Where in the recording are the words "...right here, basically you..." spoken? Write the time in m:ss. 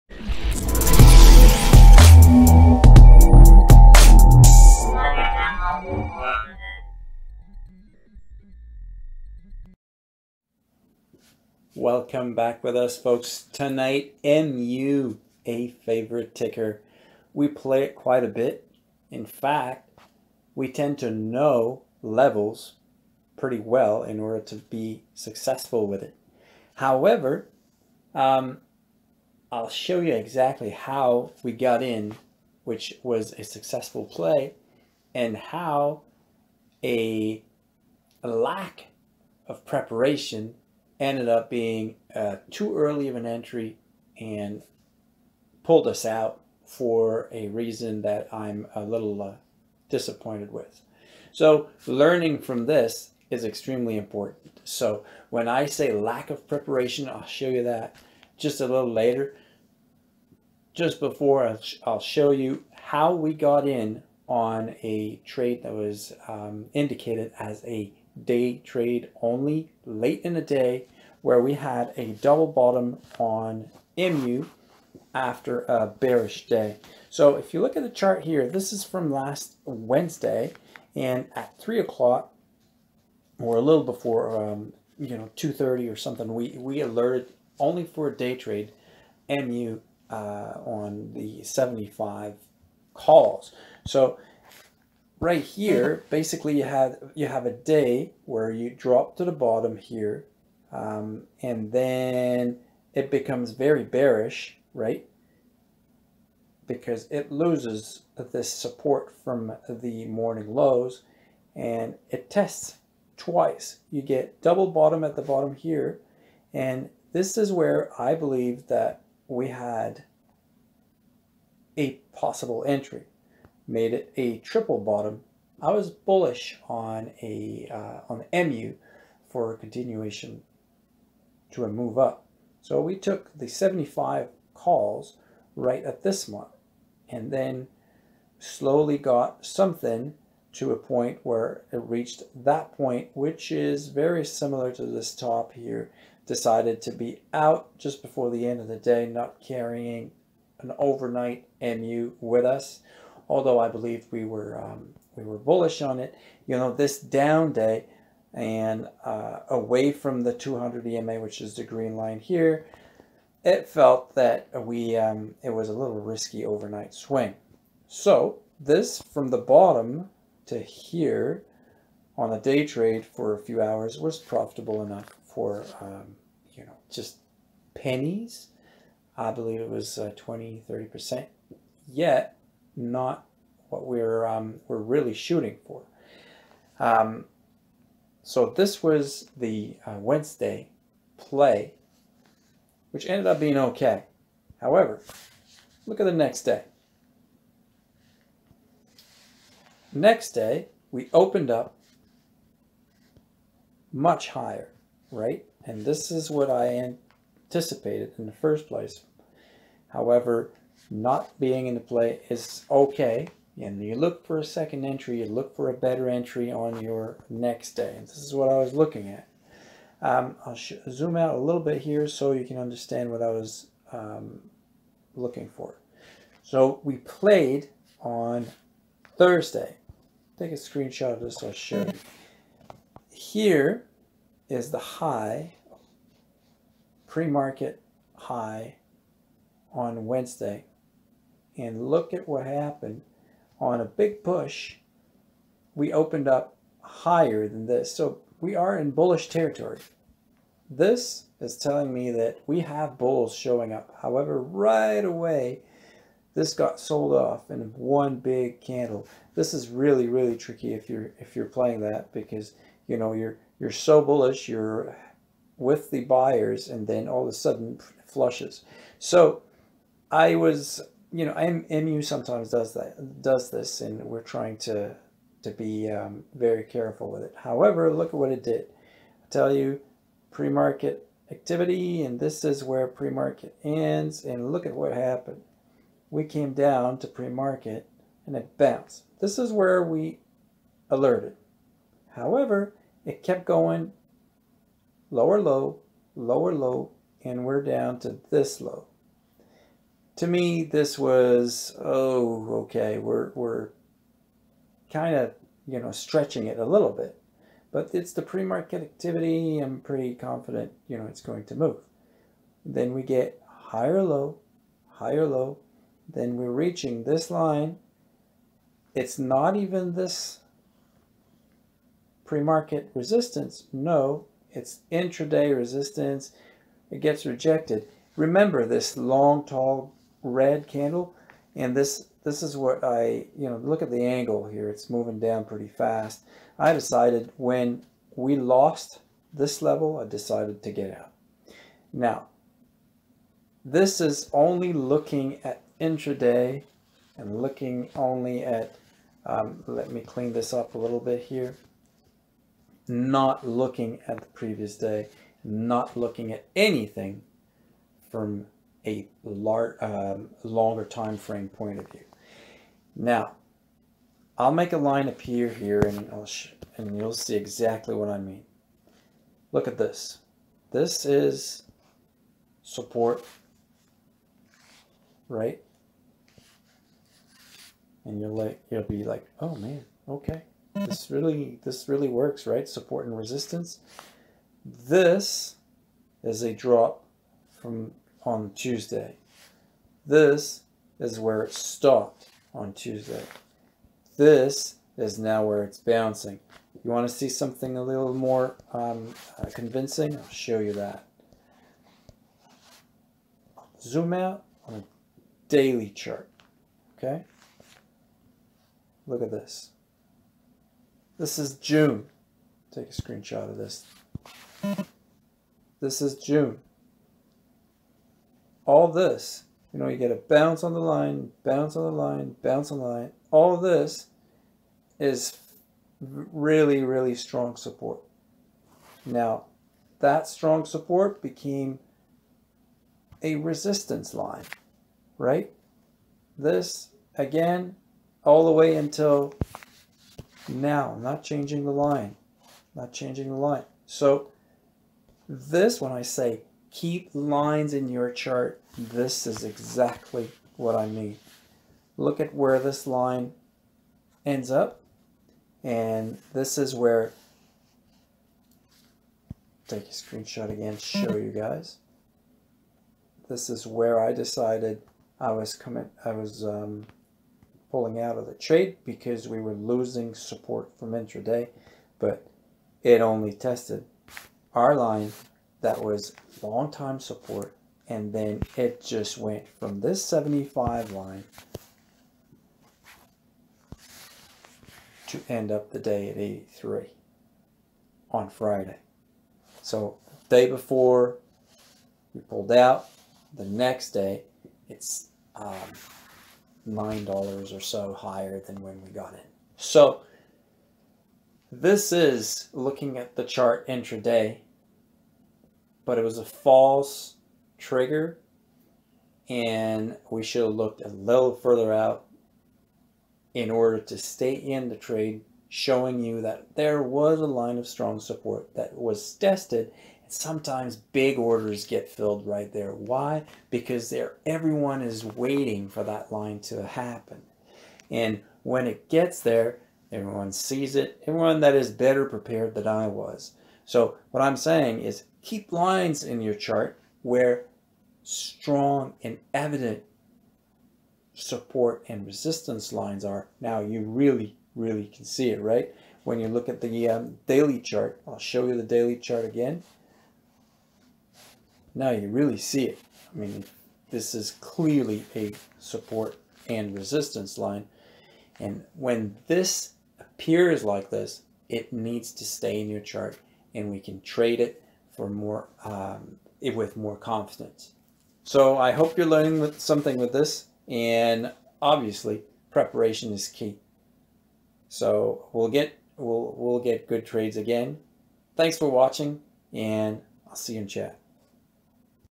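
1:35.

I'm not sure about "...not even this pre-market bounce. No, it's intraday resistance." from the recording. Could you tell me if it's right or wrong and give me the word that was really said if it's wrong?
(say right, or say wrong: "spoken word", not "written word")
wrong: "resistance", not "bounce".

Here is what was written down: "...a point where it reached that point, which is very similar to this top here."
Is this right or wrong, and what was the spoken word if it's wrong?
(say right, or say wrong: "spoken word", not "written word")
right.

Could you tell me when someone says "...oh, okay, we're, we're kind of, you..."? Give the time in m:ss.
5:01.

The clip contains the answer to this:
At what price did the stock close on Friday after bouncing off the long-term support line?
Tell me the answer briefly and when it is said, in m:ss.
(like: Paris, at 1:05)
$83, at 8:06.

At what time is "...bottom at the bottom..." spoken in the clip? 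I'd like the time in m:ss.
1:54.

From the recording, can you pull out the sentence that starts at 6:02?
Now, I'll make a line appear here and, I'll and you'll see exactly what I mean.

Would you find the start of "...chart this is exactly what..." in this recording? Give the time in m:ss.
7:28.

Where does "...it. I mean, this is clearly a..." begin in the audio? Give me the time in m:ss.
9:12.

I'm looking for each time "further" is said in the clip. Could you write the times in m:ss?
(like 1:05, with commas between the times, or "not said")
8:31.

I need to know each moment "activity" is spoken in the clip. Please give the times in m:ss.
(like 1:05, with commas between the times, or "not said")
4:41, 5:08.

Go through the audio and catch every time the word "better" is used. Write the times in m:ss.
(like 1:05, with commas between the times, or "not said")
3:35, 8:51.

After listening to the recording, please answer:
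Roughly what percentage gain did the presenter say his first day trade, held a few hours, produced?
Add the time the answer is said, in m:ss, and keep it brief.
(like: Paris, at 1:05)
20 to 30 percent, at 3:00.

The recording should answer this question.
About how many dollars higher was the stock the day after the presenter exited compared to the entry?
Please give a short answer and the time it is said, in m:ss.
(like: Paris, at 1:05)
$9, at 8:16.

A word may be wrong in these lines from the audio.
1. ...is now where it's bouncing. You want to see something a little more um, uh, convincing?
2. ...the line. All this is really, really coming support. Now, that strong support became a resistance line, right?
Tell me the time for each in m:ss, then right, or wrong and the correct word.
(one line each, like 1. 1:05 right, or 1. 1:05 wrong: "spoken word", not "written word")
1. 6:34 right
2. 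7:02 wrong: "strong", not "coming".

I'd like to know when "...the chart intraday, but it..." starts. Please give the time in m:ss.
8:23.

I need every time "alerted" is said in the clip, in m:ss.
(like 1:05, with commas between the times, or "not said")
1:26, 4:50.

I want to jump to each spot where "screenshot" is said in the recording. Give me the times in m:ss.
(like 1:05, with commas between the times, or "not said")
3:50, 6:53, 7:39.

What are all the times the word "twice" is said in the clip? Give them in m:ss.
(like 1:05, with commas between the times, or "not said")
1:53.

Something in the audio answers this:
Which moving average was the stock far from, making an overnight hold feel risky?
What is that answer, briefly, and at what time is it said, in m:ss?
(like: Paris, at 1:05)
200 EMA, at 2:40.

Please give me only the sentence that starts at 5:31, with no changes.
And this, this is what I, you know, look at the angle here.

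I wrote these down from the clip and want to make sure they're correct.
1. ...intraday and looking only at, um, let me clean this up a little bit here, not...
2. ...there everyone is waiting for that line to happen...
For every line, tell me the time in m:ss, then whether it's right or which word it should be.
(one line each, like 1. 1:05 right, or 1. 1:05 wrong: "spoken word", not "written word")
1. 5:45 right
2. 8:43 right.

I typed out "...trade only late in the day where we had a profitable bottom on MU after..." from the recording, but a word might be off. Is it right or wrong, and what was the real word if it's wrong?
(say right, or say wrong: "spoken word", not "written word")
wrong: "double", not "profitable".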